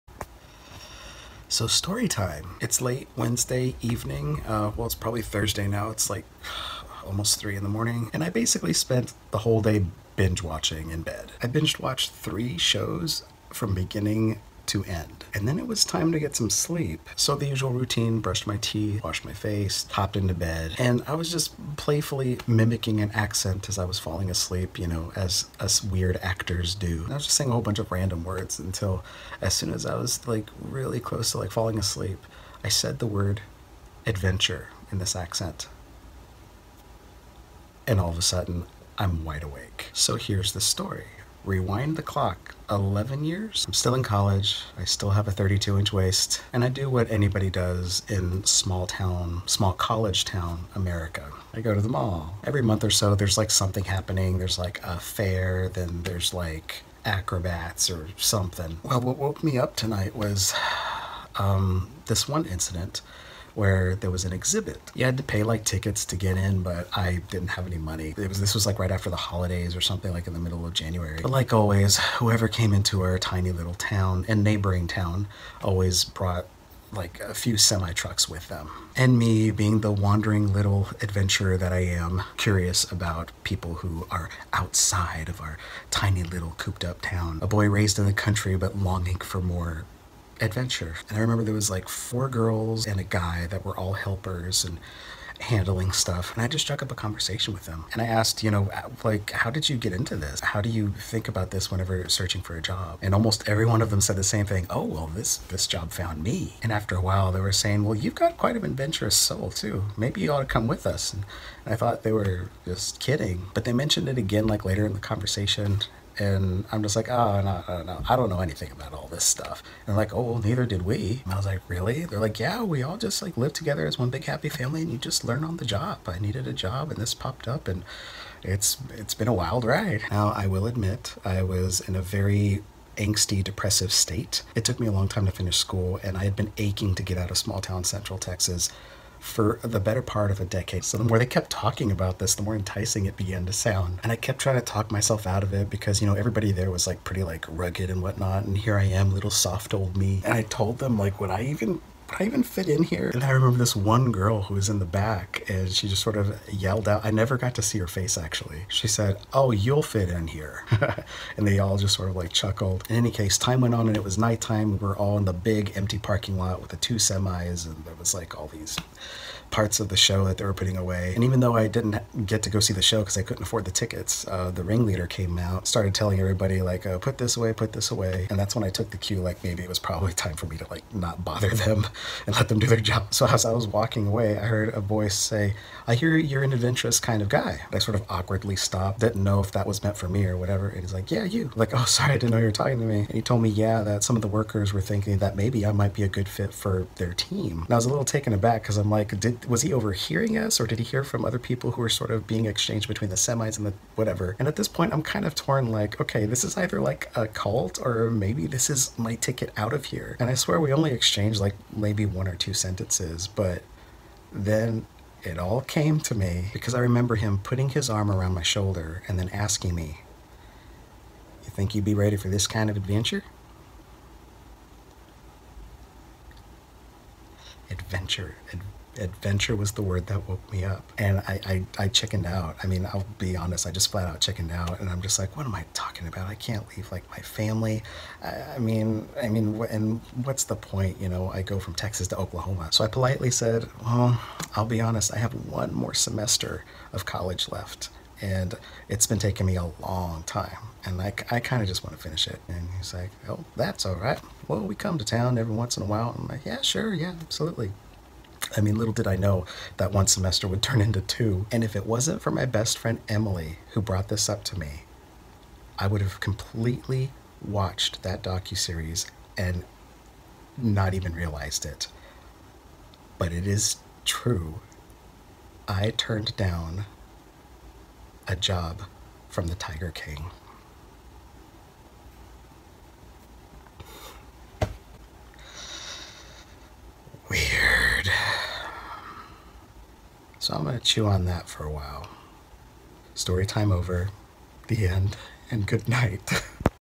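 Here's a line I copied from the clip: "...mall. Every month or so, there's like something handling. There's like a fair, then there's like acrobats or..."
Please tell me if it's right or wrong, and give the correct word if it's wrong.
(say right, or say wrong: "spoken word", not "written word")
wrong: "happening", not "handling".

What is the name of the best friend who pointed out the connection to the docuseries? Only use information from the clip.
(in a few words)
Emily.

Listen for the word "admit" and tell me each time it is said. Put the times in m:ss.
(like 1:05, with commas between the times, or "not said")
2:10.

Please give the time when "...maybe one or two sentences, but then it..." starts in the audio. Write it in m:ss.
3:31.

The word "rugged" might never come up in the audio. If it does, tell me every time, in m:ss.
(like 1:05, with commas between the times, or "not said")
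2:27.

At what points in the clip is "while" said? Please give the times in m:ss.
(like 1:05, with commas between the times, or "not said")
1:47, 4:15, 4:51.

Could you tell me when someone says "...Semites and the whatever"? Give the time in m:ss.
3:23.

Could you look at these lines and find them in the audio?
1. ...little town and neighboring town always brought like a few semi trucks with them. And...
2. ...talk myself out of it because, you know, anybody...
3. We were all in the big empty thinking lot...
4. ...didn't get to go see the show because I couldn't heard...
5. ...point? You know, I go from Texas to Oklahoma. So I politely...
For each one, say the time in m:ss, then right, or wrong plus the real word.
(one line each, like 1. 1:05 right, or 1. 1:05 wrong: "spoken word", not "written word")
1. 1:13 right
2. 2:24 wrong: "everybody", not "anybody"
3. 2:44 wrong: "parking", not "thinking"
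4. 2:51 wrong: "afford", not "heard"
5. 4:00 right.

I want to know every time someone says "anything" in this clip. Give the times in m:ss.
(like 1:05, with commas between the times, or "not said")
1:58.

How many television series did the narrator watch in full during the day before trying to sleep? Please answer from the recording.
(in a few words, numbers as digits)
3.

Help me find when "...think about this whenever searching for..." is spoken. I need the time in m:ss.
1:40.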